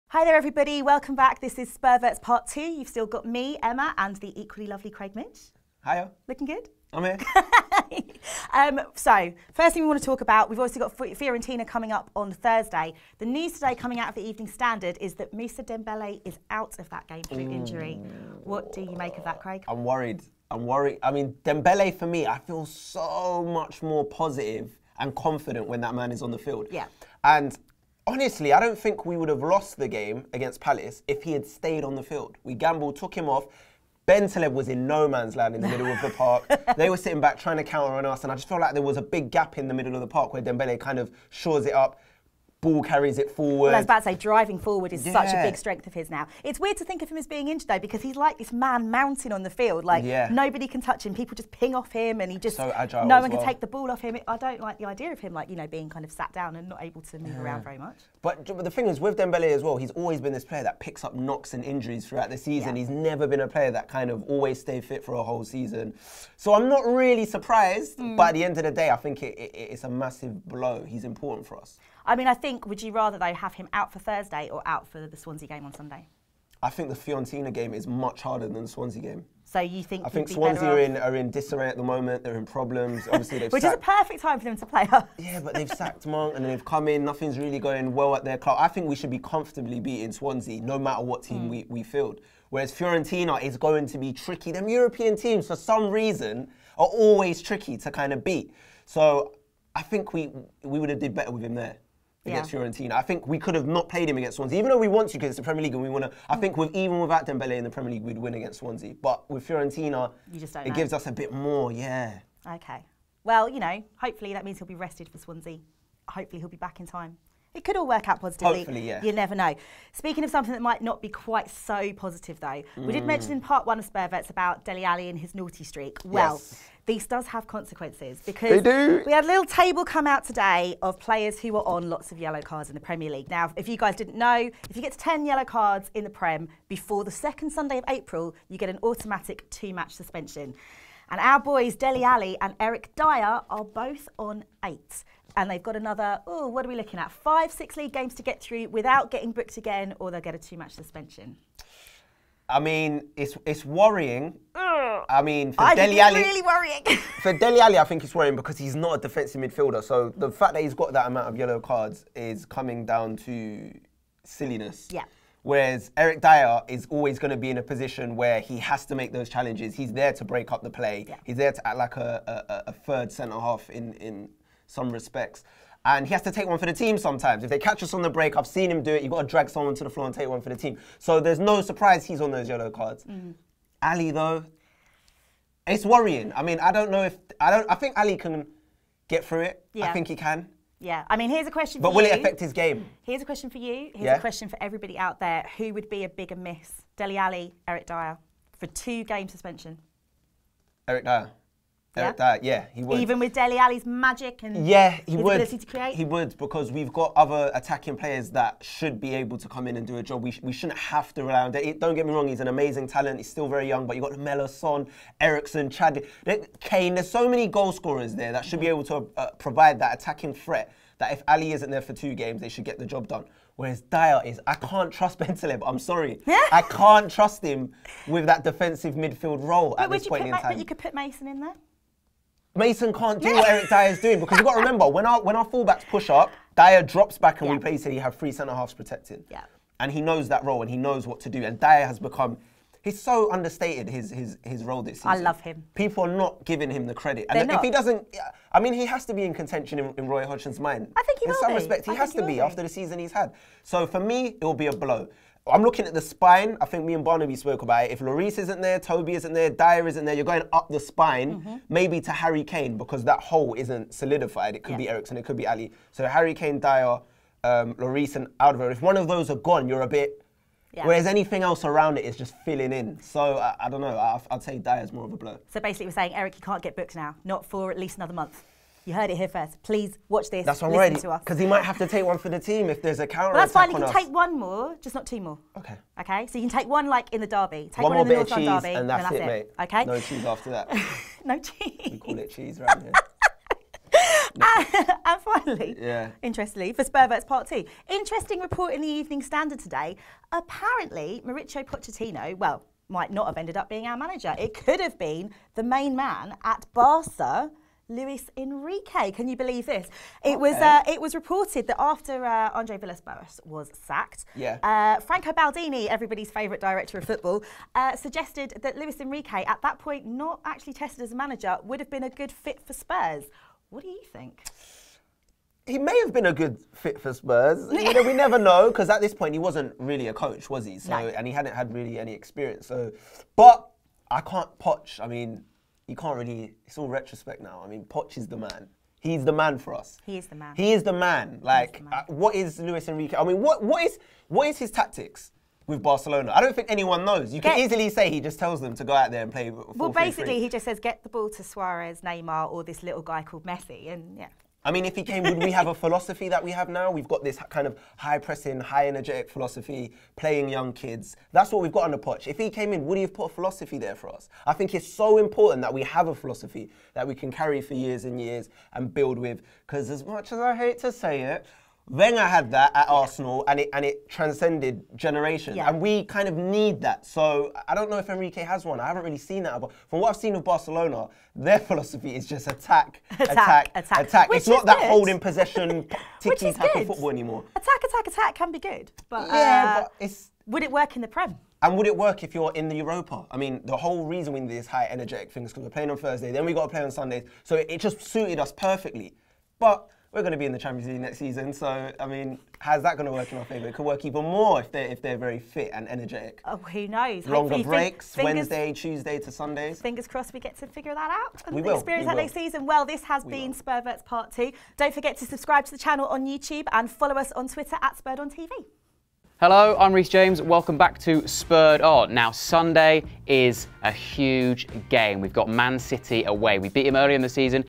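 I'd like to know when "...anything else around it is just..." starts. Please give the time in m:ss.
4:31.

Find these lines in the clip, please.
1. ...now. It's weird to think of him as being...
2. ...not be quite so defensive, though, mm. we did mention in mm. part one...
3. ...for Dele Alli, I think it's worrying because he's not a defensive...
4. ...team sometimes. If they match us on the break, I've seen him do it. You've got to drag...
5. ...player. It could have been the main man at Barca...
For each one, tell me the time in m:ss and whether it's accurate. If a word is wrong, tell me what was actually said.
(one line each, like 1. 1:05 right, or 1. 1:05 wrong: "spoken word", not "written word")
1. 0:46 right
2. 2:00 wrong: "positive", not "defensive"
3. 2:37 right
4. 2:56 wrong: "catch", not "match"
5. 5:03 wrong: "manager", not "player".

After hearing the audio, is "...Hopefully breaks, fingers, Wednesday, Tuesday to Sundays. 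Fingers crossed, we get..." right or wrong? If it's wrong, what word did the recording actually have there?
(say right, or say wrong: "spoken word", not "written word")
right.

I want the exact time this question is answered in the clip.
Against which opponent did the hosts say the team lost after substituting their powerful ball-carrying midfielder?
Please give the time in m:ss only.
0:30.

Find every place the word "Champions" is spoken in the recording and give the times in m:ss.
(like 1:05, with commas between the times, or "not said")
6:40.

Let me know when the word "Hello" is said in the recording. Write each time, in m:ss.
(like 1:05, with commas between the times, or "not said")
6:59.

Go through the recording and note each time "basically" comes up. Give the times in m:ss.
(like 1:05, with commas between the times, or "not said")
3:57, 4:35, 5:49.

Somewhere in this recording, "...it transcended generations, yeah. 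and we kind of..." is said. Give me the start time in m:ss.
6:13.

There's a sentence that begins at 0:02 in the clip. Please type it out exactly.
You've still got me, Emma, and the equally lovely Craig Mitch.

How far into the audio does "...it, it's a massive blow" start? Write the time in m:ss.
1:09.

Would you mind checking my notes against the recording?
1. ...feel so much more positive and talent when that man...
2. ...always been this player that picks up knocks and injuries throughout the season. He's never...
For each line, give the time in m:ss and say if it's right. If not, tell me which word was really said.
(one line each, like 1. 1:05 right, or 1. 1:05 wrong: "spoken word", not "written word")
1. 0:22 wrong: "confident", not "talent"
2. 0:59 right.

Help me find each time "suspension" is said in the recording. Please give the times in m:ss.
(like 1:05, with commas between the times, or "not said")
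2:19, 2:30, 3:19.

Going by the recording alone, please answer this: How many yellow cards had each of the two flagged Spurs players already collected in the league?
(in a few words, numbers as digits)
8.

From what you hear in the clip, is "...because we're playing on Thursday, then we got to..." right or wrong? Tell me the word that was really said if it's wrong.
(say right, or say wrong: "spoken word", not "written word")
right.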